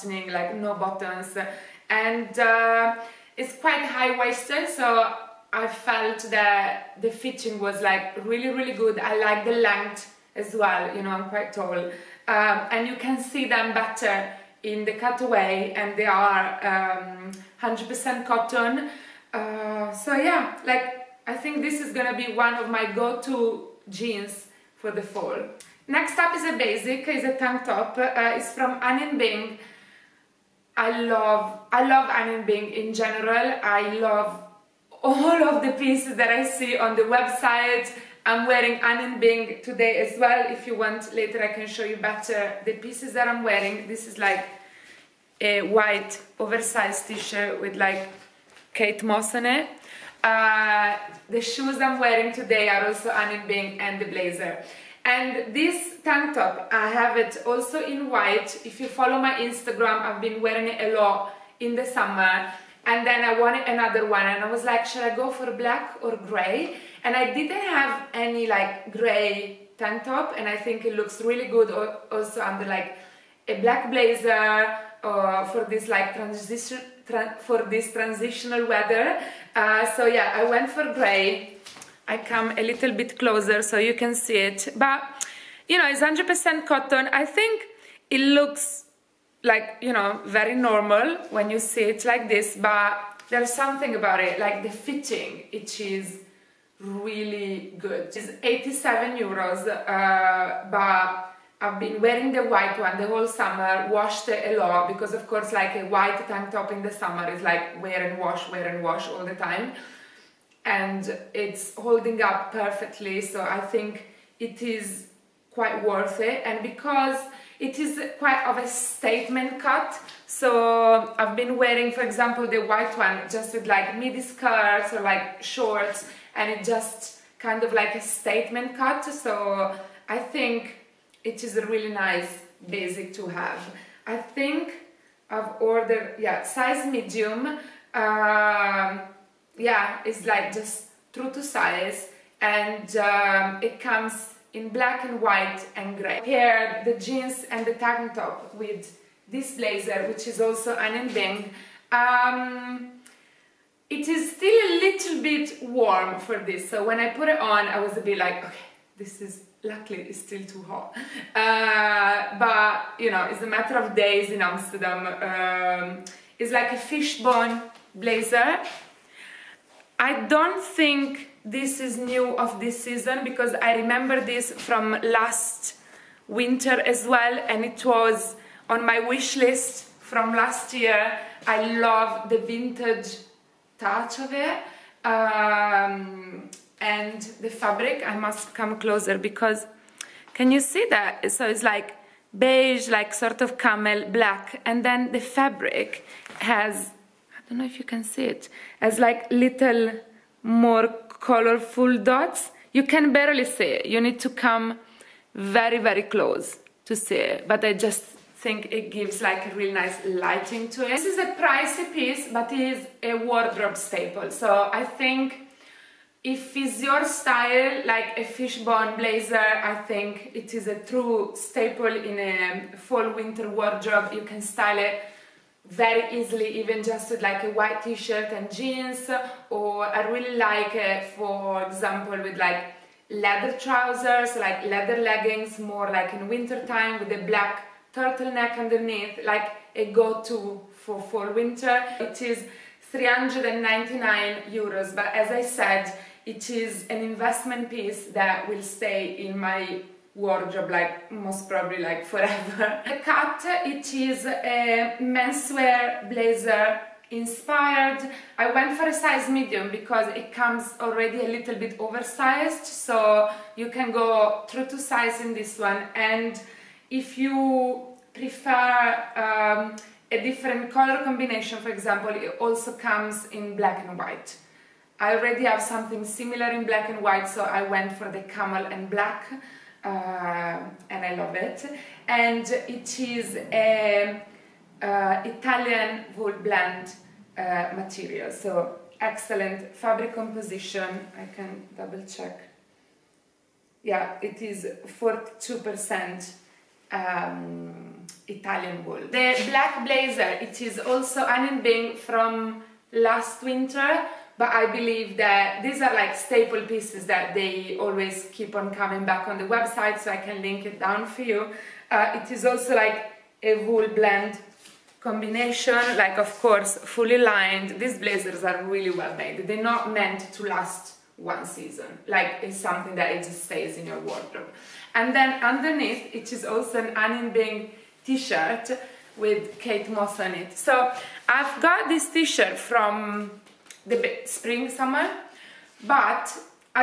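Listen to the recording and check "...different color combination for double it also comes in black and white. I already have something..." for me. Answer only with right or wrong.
wrong.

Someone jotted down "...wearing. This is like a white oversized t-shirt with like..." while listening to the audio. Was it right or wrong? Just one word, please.
right.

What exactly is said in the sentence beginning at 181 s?
I love the vintage touch of it um, and the fabric.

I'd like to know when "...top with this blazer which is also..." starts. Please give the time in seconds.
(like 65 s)
148 s.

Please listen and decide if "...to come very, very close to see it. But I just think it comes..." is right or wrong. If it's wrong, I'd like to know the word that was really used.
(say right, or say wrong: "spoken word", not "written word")
wrong: "gives", not "comes".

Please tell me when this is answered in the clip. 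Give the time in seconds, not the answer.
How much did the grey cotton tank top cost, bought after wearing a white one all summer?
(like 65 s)
98 s.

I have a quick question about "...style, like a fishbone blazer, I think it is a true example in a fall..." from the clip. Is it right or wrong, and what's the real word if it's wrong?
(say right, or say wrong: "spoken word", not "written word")
wrong: "staple", not "example".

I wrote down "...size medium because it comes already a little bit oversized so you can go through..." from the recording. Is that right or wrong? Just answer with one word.
right.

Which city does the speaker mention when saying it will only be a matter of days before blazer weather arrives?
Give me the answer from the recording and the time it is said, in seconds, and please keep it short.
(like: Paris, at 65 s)
Amsterdam, at 164 s.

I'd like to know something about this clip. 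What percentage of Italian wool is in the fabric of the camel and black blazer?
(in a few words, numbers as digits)
42%.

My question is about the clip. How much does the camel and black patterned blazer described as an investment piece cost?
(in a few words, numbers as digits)
399 euros.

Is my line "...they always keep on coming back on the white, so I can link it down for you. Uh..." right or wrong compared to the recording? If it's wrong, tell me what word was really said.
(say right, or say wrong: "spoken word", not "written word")
wrong: "website", not "white".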